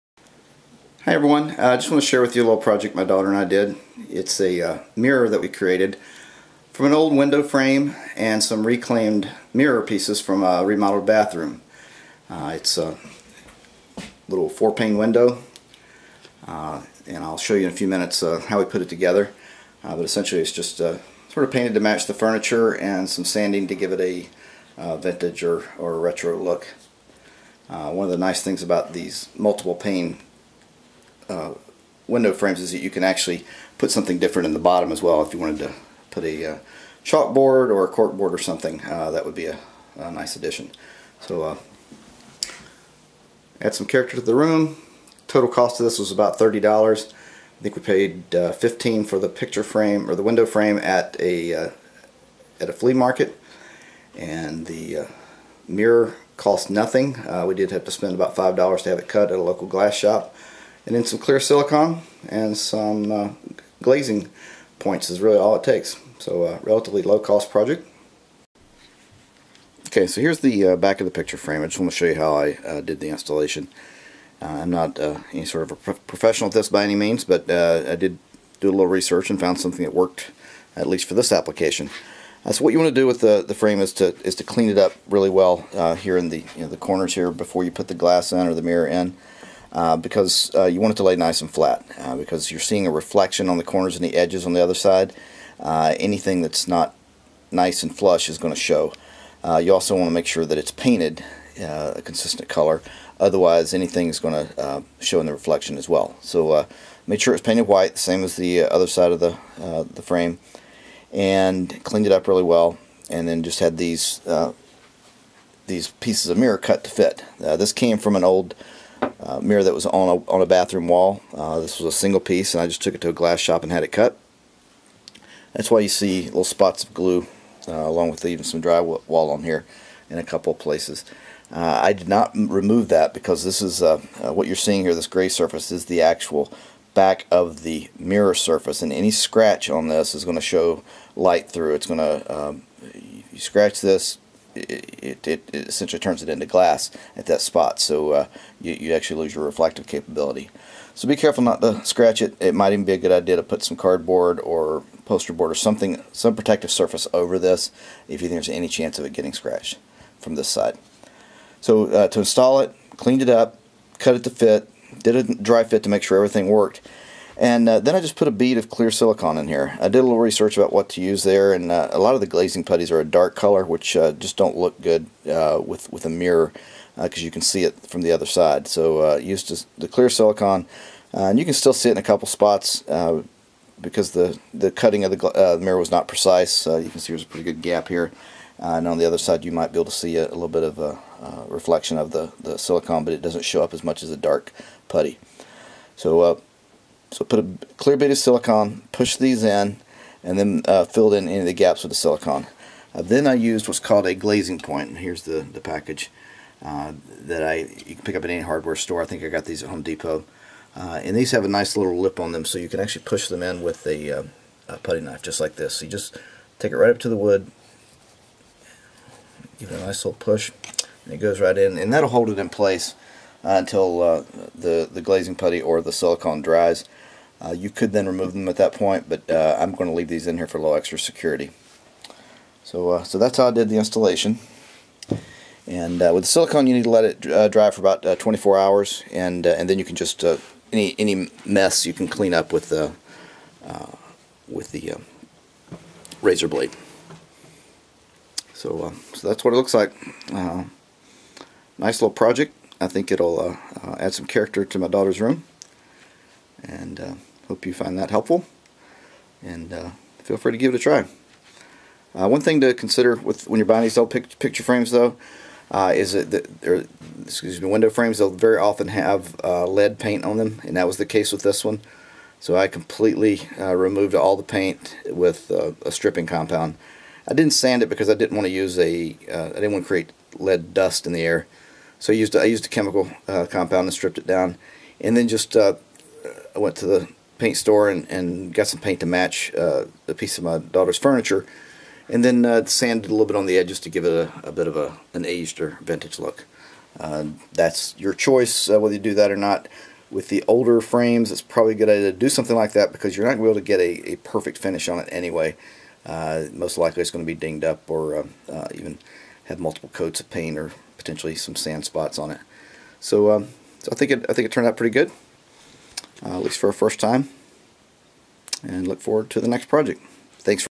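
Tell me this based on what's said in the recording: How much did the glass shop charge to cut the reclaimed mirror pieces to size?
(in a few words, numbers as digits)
$5.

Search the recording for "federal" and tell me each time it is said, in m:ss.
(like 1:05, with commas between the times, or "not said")
not said.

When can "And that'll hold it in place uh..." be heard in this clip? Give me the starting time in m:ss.
3:41.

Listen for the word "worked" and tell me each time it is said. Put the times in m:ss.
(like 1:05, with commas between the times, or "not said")
1:19, 2:46.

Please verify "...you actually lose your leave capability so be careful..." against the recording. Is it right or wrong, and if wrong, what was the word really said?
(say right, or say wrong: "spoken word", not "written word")
wrong: "reflective", not "leave".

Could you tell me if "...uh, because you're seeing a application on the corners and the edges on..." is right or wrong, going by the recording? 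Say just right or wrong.
wrong.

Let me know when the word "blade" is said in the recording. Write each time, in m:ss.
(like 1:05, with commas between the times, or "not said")
4:06.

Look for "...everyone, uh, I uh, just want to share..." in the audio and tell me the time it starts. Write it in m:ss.
0:01.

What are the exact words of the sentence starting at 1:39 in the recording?
Uh, you also want to make sure that it's painted a consistent color.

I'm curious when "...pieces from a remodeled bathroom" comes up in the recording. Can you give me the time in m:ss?
0:09.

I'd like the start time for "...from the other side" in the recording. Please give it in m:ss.
2:57.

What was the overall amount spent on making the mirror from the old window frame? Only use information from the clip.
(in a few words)
$30.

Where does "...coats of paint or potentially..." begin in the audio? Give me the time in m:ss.
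5:09.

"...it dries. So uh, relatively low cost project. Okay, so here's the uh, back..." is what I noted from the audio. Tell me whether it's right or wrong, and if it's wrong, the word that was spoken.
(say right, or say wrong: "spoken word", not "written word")
wrong: "takes", not "dries".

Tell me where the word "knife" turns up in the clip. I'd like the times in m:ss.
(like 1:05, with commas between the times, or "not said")
3:35.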